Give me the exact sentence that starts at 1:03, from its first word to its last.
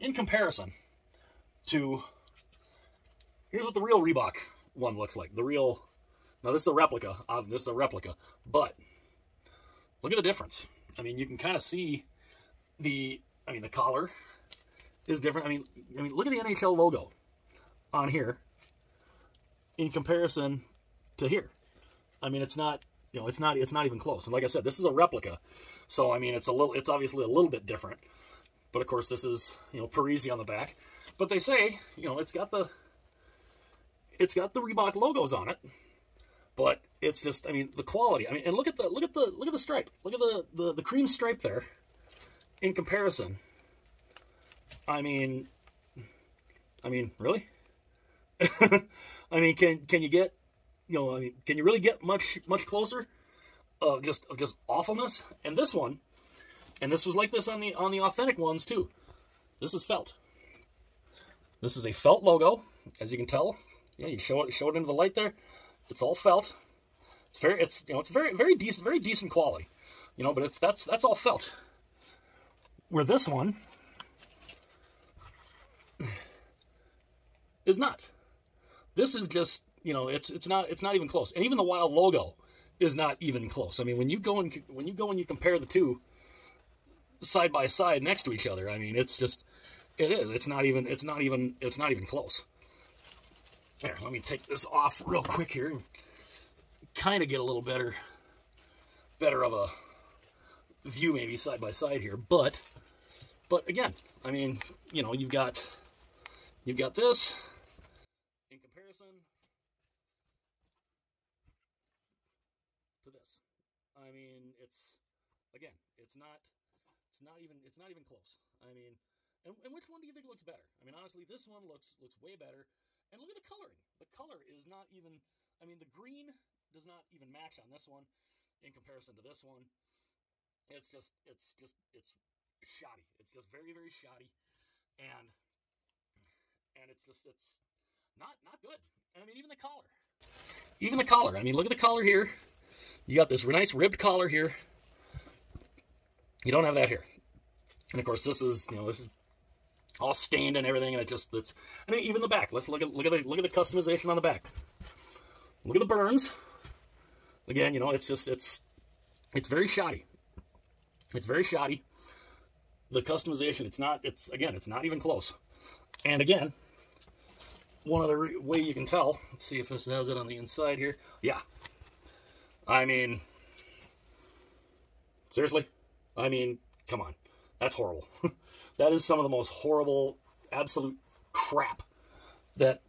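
Yeah, you show it show it into the light there.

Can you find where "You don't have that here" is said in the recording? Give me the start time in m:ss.
2:26.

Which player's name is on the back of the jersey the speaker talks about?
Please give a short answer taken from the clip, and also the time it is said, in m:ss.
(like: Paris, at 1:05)
Parise, at 0:29.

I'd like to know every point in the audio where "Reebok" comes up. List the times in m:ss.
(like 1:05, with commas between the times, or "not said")
0:04, 0:34.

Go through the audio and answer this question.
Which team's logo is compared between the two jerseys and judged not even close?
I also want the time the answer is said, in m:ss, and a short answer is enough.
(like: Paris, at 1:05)
Wild, at 1:21.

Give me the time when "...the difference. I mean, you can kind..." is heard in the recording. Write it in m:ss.
0:10.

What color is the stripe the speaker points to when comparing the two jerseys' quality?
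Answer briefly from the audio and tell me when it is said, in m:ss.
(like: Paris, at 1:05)
Cream, at 0:40.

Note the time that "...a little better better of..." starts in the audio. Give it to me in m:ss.
1:37.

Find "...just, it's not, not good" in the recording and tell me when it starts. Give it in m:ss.
2:17.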